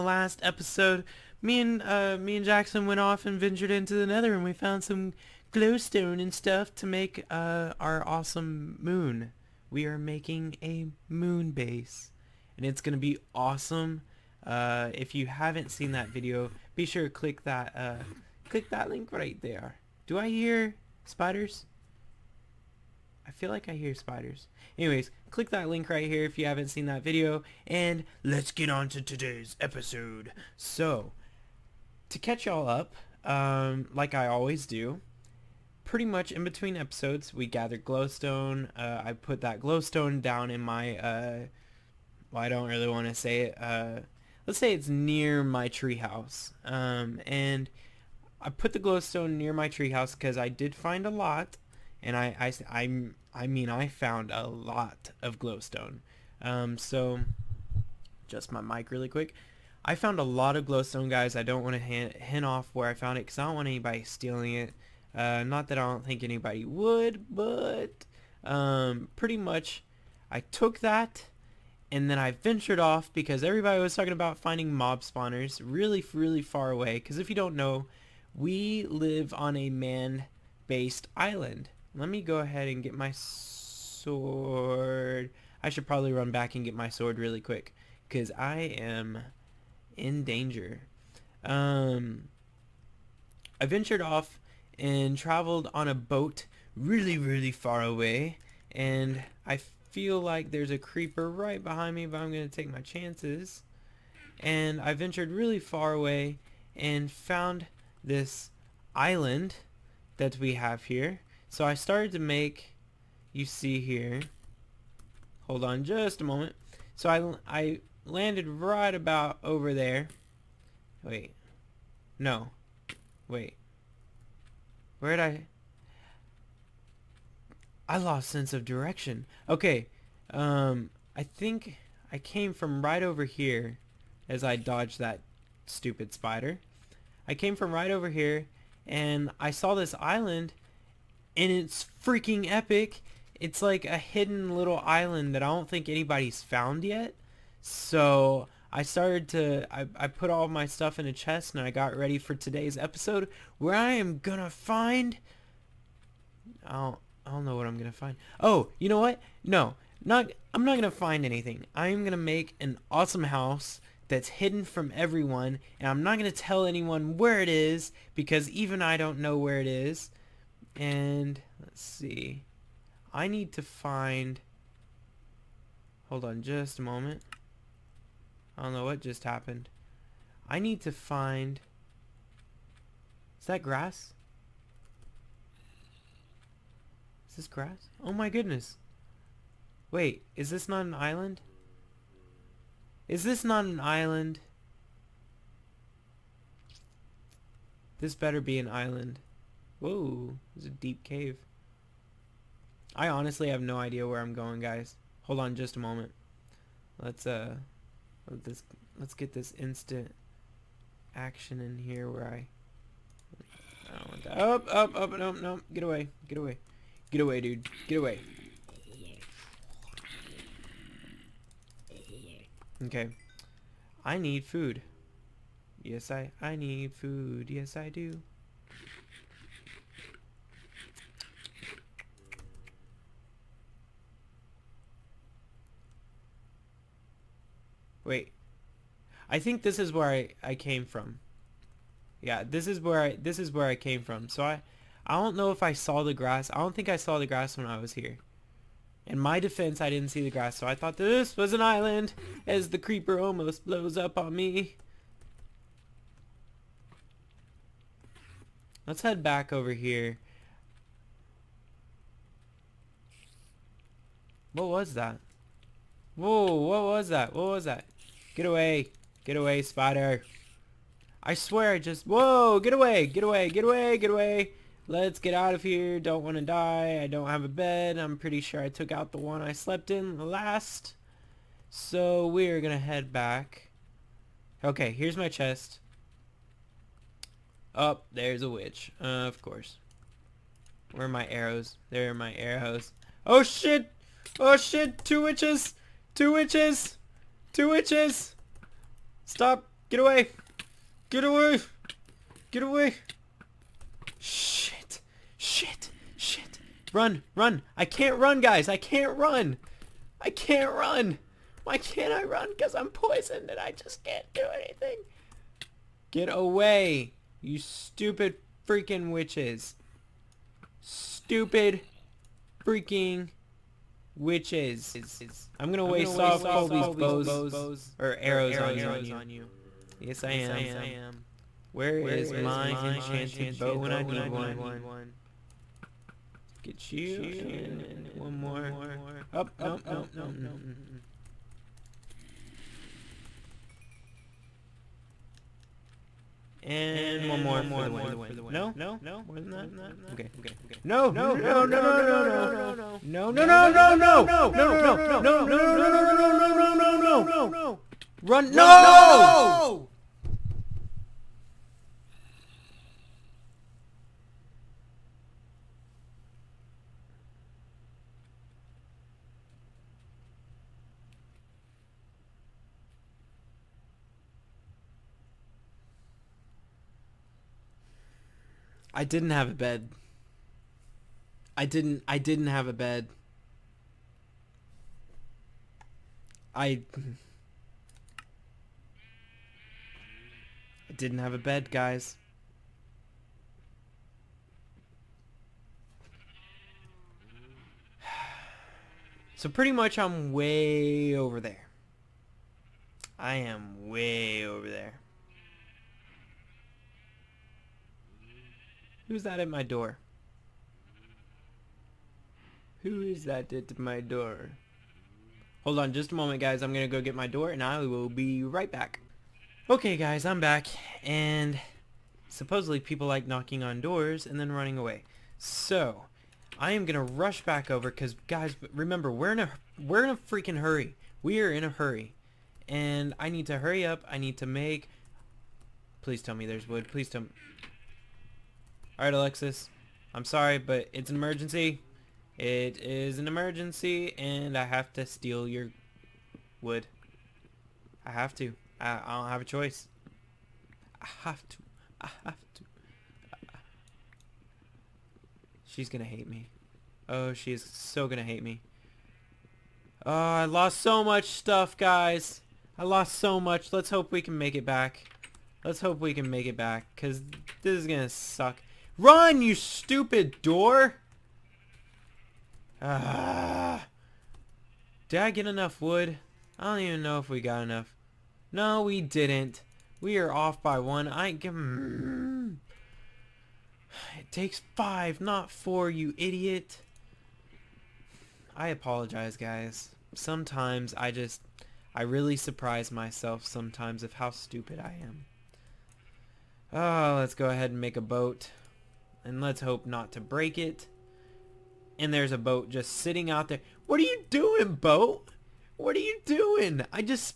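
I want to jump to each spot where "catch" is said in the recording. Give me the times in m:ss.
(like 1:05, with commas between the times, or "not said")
0:32.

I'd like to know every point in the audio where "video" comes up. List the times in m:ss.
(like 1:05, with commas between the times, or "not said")
0:16, 0:27.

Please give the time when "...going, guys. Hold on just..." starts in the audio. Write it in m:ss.
3:24.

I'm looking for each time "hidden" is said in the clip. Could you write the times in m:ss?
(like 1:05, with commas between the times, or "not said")
2:23, 2:44.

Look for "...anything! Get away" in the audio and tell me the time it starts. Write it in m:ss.
5:14.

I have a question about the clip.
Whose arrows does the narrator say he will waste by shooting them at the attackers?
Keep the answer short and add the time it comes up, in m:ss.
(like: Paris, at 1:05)
Colby's, at 5:26.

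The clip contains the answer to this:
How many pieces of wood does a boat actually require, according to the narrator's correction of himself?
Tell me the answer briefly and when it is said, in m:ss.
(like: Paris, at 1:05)
5, at 8:04.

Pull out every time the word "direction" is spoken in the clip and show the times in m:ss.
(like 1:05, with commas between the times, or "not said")
2:08.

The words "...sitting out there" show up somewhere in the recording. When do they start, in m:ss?
8:22.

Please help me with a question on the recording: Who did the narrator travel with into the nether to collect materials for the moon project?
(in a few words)
Jackson.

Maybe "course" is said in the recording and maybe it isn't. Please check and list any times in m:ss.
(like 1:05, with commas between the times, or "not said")
4:49.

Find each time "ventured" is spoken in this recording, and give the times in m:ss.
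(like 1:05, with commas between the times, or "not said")
0:03, 1:12, 1:33, 1:44.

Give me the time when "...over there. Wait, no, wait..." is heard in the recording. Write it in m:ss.
1:59.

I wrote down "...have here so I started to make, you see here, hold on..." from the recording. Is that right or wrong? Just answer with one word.
right.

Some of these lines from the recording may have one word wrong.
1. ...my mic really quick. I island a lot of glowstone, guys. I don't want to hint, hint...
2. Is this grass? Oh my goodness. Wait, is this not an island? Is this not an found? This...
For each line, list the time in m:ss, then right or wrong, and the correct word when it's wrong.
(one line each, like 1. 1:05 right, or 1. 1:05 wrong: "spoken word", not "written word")
1. 0:58 wrong: "found", not "island"
2. 3:07 wrong: "island", not "found".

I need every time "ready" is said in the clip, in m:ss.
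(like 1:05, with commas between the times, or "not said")
2:31.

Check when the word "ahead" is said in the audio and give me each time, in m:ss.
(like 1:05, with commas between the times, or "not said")
1:22, 8:17.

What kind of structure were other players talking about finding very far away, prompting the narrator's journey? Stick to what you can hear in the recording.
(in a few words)
mob spawners.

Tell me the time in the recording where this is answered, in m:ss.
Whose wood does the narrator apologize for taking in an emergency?
7:19.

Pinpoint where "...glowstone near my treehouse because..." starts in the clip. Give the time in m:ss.
0:48.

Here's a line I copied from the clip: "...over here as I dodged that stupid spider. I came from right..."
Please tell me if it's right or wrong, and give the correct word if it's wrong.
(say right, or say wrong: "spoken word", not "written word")
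right.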